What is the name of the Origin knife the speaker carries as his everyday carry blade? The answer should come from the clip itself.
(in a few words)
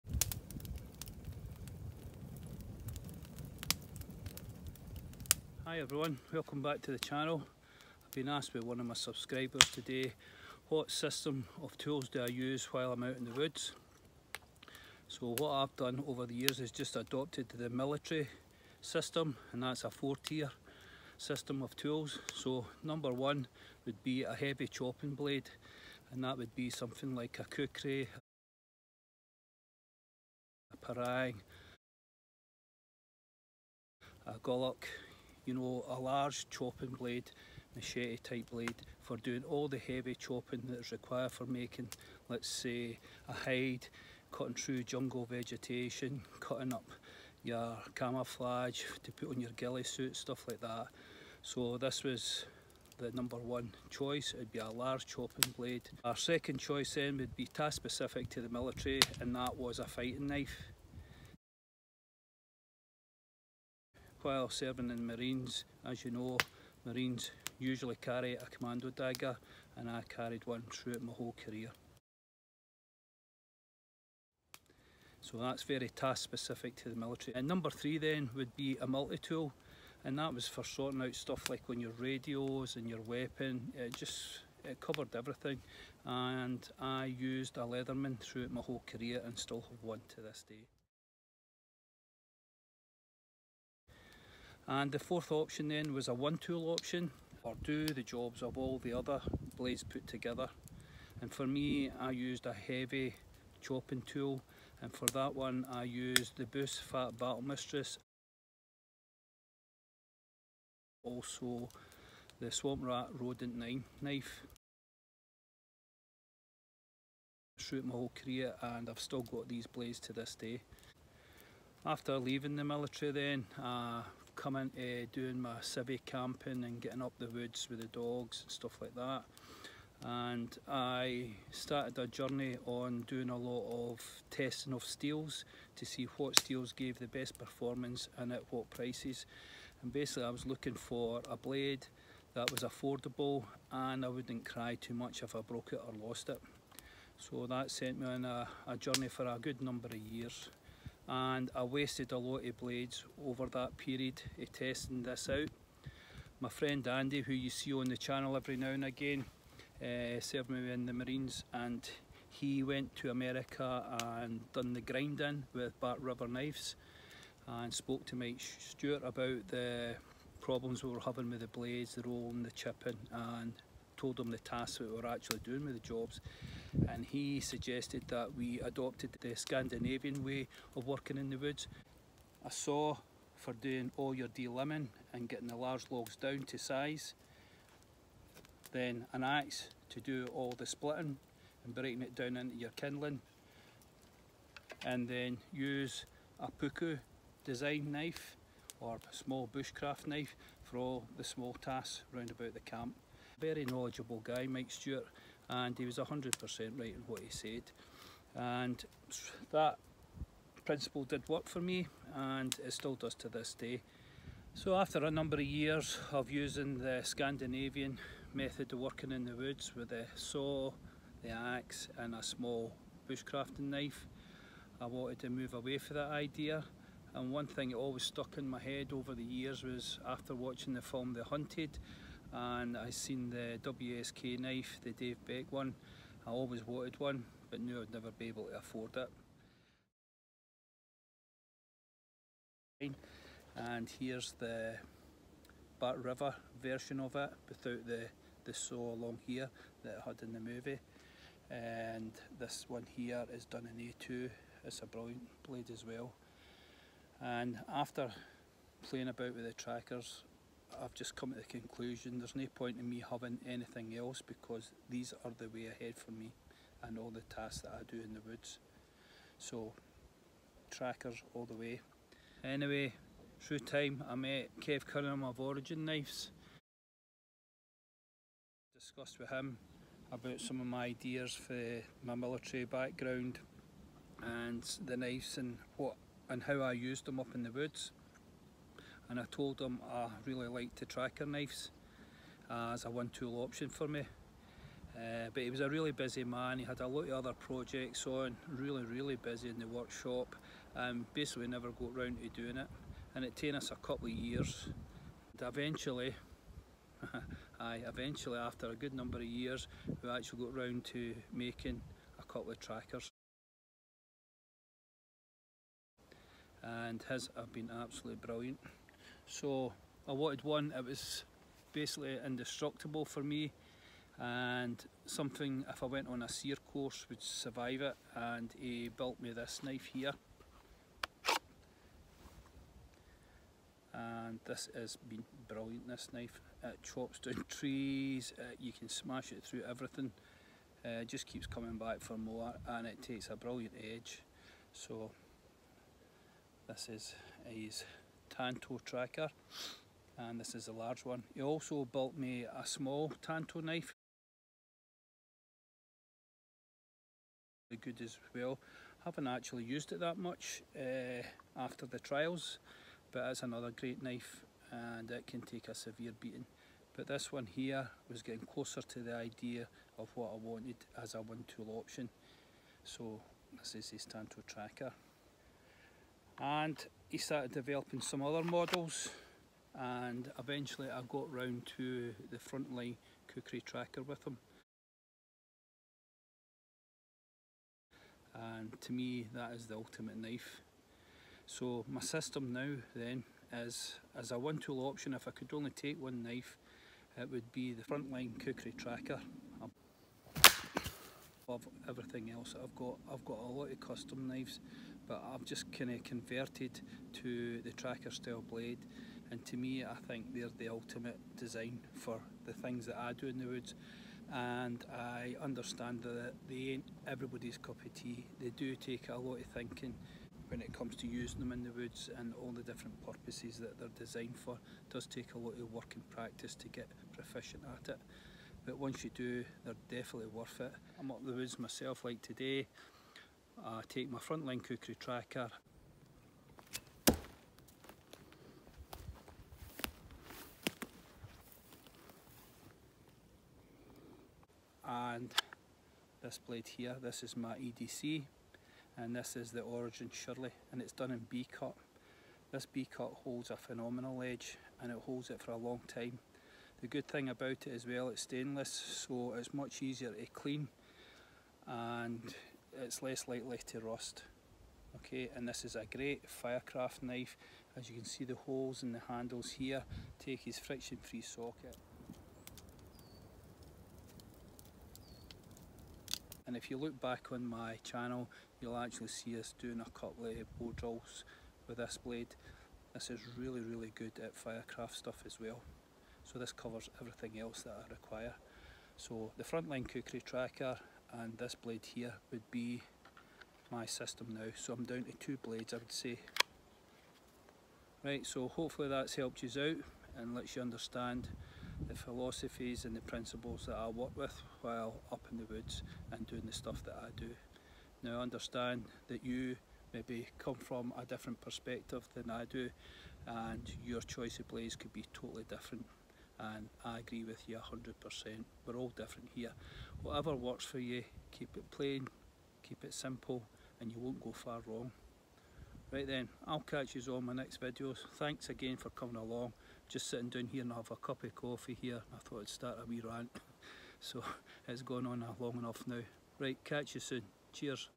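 Shirley.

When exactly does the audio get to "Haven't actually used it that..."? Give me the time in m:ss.
5:59.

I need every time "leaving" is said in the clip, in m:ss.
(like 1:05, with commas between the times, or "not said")
2:02.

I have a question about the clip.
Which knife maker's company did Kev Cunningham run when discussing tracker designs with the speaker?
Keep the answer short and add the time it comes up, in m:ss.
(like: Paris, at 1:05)
Origin Knives, at 4:35.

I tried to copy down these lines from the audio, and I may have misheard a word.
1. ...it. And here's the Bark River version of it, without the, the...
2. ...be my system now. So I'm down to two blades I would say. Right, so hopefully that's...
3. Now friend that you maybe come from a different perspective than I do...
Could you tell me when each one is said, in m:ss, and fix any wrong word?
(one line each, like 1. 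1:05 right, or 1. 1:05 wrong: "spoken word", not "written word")
1. 3:58 right
2. 8:12 right
3. 8:28 wrong: "understand", not "friend".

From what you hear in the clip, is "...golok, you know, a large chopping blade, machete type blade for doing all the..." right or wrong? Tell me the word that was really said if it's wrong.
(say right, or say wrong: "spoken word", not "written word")
right.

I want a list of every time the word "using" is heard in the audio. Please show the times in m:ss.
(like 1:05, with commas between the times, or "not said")
3:36, 7:01.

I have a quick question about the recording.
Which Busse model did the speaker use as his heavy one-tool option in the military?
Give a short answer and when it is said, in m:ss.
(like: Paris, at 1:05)
Fat Battle Mistress, at 1:46.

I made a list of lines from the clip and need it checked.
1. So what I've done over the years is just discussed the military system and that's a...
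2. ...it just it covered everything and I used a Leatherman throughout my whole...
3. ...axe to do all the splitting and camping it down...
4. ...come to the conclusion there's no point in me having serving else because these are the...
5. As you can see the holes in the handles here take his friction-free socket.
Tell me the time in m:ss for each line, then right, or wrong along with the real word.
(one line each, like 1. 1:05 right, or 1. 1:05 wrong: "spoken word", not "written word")
1. 0:15 wrong: "adopted", not "discussed"
2. 1:23 right
3. 3:09 wrong: "breaking", not "camping"
4. 4:21 wrong: "anything", not "serving"
5. 7:47 right.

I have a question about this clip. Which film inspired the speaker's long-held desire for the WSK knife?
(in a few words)
The Hunted.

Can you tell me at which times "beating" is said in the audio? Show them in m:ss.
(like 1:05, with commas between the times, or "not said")
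6:06.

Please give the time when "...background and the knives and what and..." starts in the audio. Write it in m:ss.
4:42.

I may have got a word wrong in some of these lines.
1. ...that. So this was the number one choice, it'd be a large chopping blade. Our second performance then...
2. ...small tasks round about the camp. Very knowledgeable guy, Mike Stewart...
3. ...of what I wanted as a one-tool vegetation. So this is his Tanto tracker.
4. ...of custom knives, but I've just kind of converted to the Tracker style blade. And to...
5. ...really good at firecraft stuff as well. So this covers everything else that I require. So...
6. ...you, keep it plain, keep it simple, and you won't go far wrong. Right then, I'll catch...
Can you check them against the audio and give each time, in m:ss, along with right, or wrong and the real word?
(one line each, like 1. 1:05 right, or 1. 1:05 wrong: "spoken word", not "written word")
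1. 0:50 wrong: "choice", not "performance"
2. 3:21 right
3. 6:09 wrong: "option", not "vegetation"
4. 6:43 right
5. 8:03 right
6. 8:40 right.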